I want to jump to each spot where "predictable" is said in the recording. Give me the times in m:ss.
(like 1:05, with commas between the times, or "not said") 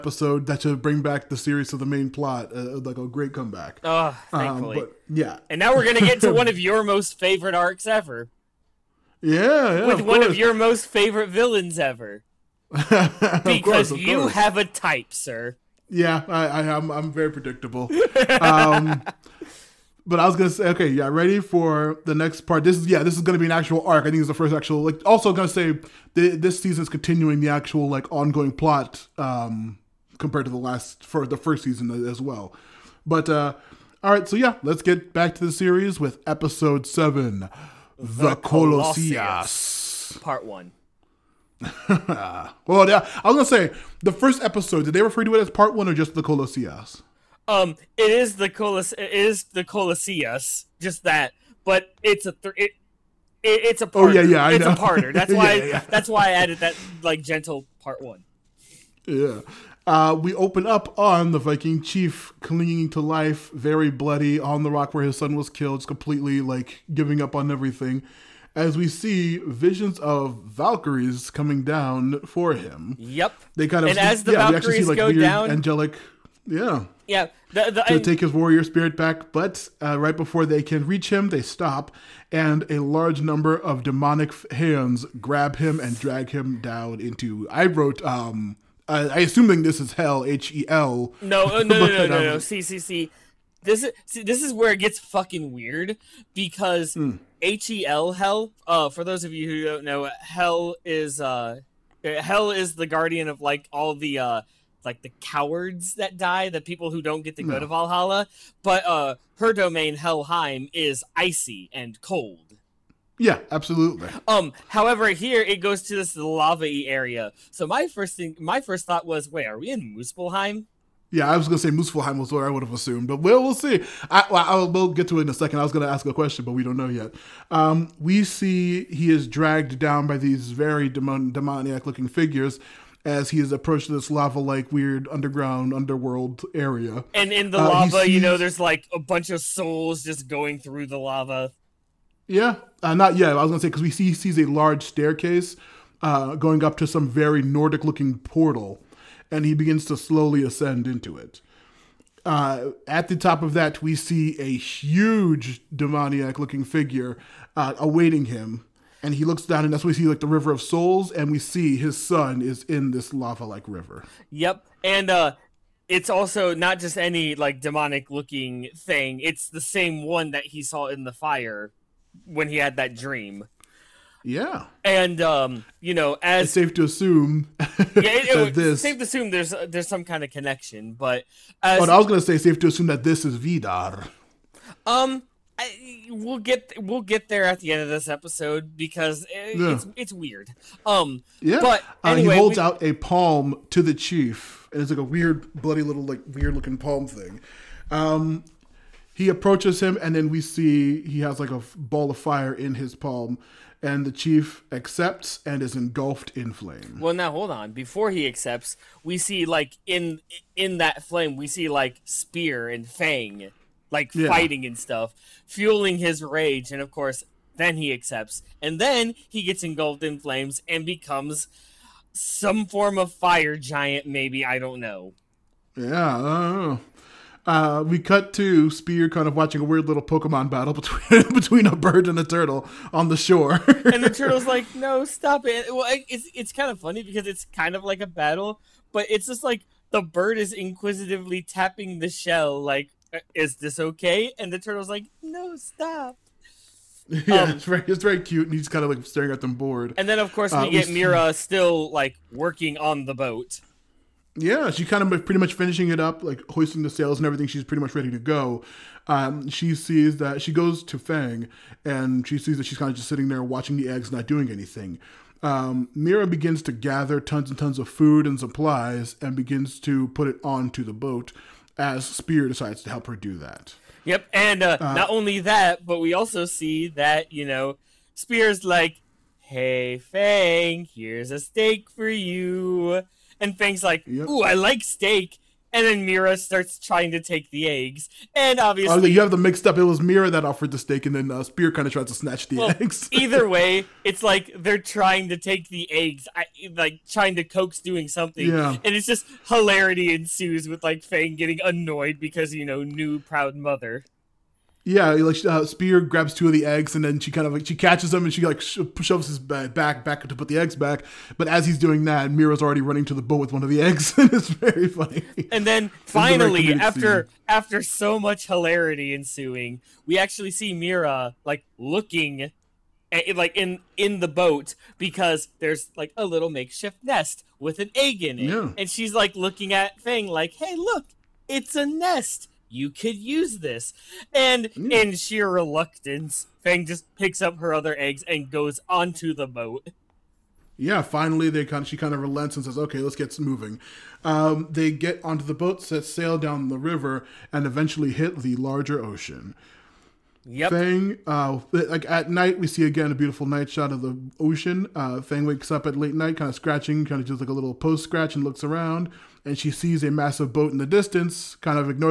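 0:17.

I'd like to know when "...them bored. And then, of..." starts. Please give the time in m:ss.
4:09.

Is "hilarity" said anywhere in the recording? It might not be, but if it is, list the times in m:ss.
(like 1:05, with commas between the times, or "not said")
4:59, 5:18.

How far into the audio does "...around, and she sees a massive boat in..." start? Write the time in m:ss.
5:58.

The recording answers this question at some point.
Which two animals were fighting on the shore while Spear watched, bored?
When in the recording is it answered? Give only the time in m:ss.
3:51.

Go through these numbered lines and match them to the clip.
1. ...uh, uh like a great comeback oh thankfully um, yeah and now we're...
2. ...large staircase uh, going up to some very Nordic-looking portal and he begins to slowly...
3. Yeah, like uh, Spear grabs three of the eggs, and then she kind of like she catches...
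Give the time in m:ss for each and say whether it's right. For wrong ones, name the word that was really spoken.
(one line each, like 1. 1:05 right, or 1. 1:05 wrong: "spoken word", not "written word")
1. 0:02 right
2. 2:24 right
3. 5:04 wrong: "two", not "three".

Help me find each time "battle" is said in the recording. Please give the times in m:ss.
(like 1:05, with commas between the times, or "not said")
3:50, 3:58.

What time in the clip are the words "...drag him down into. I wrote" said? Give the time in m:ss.
1:25.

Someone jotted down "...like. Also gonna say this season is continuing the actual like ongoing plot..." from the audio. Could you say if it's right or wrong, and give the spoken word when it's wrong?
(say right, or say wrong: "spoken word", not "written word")
right.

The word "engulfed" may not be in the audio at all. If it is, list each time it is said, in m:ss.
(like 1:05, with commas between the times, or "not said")
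3:25, 3:39.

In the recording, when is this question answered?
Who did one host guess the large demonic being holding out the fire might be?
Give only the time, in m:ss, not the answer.
3:03.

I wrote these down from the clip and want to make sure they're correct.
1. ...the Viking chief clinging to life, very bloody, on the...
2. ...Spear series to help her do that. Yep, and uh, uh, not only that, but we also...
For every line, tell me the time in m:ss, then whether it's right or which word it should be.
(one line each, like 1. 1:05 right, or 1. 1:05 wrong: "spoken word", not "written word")
1. 1:01 right
2. 4:32 wrong: "decides", not "series".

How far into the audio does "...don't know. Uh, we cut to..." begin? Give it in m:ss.
3:46.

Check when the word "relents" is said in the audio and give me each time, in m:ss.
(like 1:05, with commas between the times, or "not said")
5:42.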